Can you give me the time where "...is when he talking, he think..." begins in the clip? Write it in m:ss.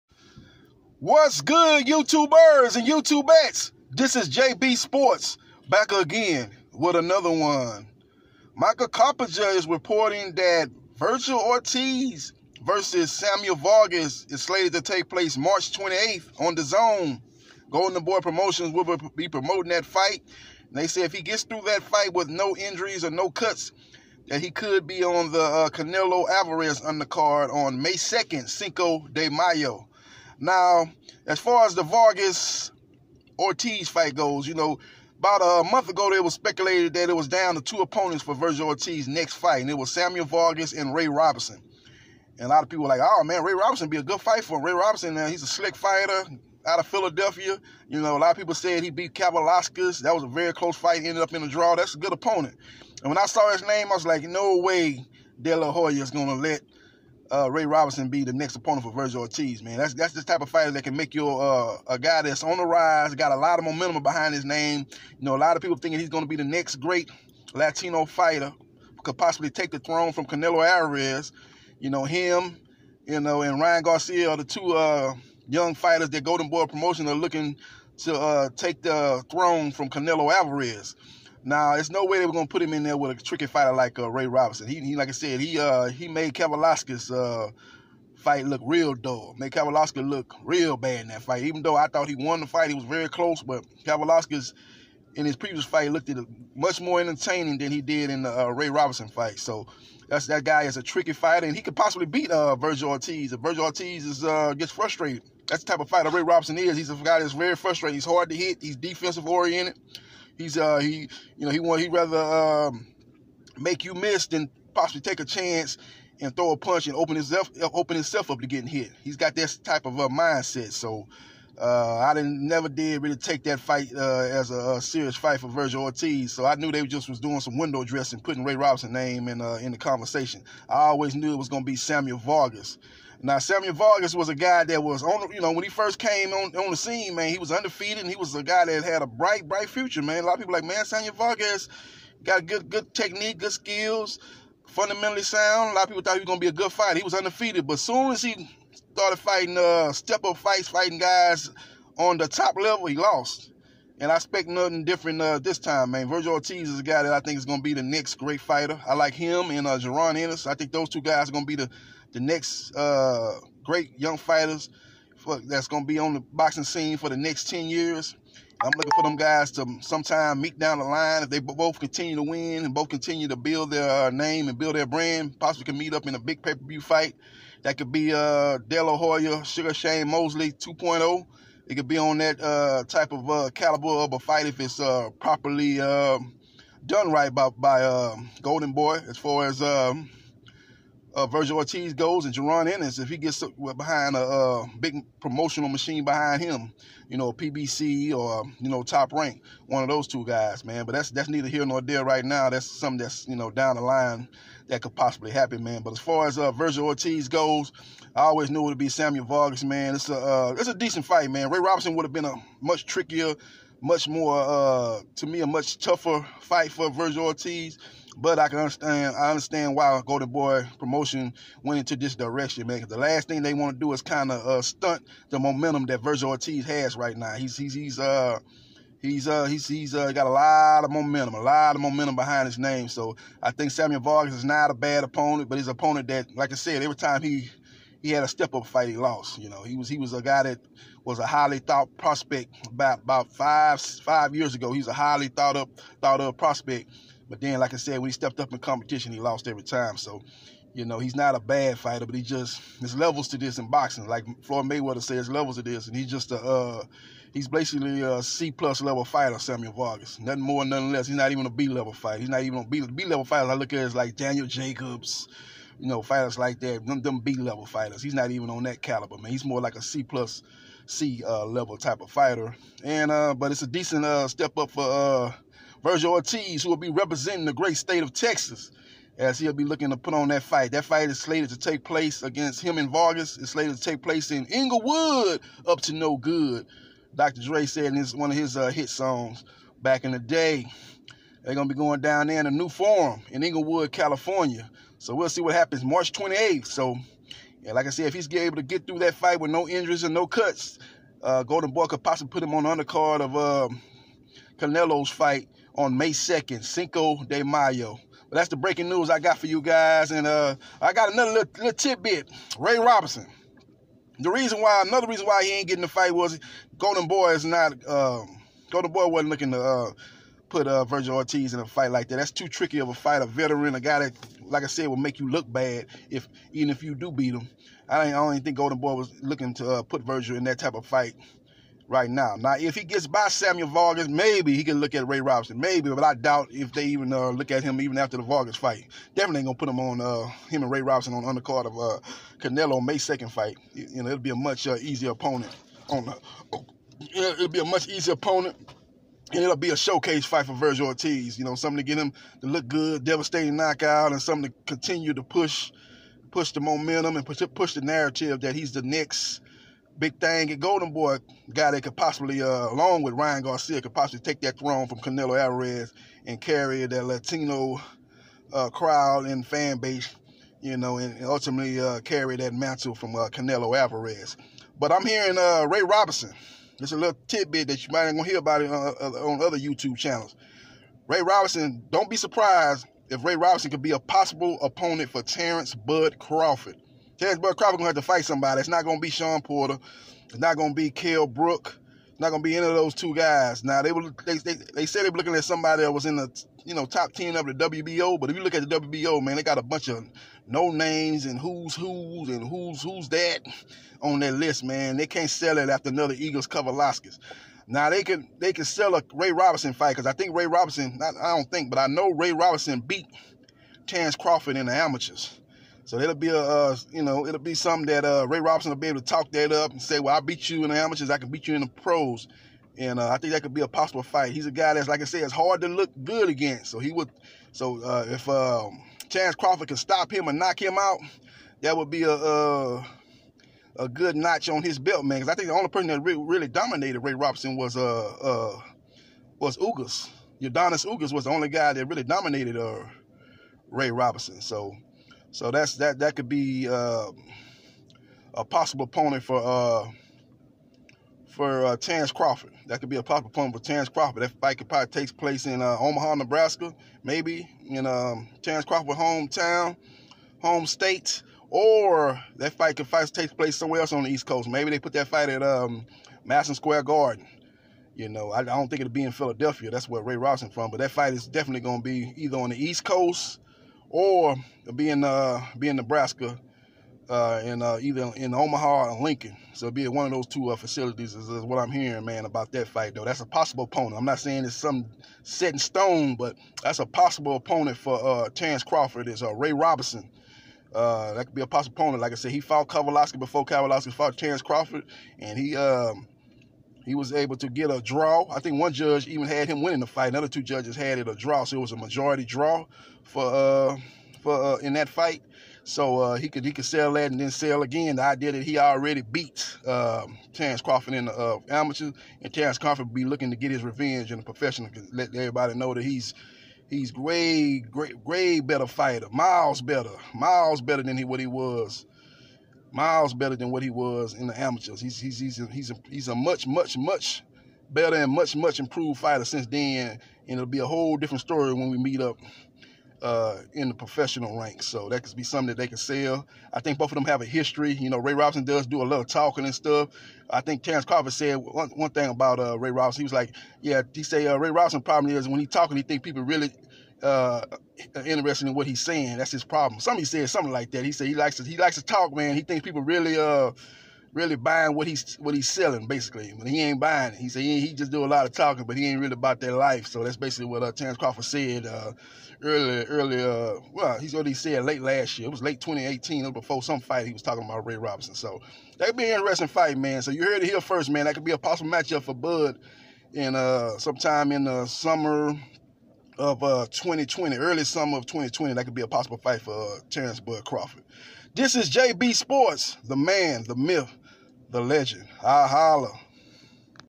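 9:05.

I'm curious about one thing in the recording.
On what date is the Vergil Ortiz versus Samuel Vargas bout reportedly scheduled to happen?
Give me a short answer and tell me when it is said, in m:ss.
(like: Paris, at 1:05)
March 28th, at 0:15.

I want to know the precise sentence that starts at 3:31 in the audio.
Ray Robinson would have been a much trickier, much more uh, to me a much tougher fight for Vergil Ortiz.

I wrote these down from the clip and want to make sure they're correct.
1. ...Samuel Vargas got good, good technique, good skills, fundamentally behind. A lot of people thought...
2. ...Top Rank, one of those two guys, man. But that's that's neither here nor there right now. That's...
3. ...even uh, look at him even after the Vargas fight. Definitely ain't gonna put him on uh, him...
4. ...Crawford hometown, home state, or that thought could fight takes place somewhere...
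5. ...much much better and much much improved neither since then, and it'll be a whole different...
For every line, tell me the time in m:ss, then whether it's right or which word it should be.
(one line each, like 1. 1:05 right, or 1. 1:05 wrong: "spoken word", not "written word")
1. 2:20 wrong: "sound", not "behind"
2. 3:18 right
3. 5:36 right
4. 7:38 wrong: "fight", not "thought"
5. 8:46 wrong: "fighter", not "neither".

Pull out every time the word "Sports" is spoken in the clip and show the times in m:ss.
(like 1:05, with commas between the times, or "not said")
0:04, 9:42.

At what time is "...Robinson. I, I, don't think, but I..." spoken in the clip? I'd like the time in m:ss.
6:50.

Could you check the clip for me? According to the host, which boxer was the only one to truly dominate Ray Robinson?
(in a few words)
Yordenis Ugas.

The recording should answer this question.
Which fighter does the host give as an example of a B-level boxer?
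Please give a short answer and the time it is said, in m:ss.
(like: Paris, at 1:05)
Daniel Jacobs, at 4:23.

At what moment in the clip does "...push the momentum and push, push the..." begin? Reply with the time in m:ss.
5:56.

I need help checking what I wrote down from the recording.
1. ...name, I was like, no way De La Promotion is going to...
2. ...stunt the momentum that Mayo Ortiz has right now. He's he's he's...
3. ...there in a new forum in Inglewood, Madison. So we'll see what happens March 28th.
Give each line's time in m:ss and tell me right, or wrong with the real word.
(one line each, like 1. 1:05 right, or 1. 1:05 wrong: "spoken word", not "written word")
1. 0:53 wrong: "Hoya", not "Promotion"
2. 3:44 wrong: "Vergil", not "Mayo"
3. 4:52 wrong: "California", not "Madison".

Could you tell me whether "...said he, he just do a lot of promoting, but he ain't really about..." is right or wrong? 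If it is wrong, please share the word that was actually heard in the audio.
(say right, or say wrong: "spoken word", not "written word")
wrong: "talking", not "promoting".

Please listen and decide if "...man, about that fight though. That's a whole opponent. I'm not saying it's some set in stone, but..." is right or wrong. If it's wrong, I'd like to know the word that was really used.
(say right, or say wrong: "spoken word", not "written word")
wrong: "possible", not "whole".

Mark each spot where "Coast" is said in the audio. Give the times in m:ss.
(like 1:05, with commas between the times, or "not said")
7:44, 7:52.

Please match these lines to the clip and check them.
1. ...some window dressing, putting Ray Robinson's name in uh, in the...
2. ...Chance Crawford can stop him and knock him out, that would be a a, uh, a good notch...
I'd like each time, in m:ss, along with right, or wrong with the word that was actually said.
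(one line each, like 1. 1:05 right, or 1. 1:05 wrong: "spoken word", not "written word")
1. 2:07 right
2. 7:09 right.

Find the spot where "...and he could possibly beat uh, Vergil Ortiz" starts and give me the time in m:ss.
1:41.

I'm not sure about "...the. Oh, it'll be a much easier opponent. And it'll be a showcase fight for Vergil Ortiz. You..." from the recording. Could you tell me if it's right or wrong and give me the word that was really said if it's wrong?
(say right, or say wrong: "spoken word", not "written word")
right.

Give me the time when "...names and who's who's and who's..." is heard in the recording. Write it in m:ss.
6:40.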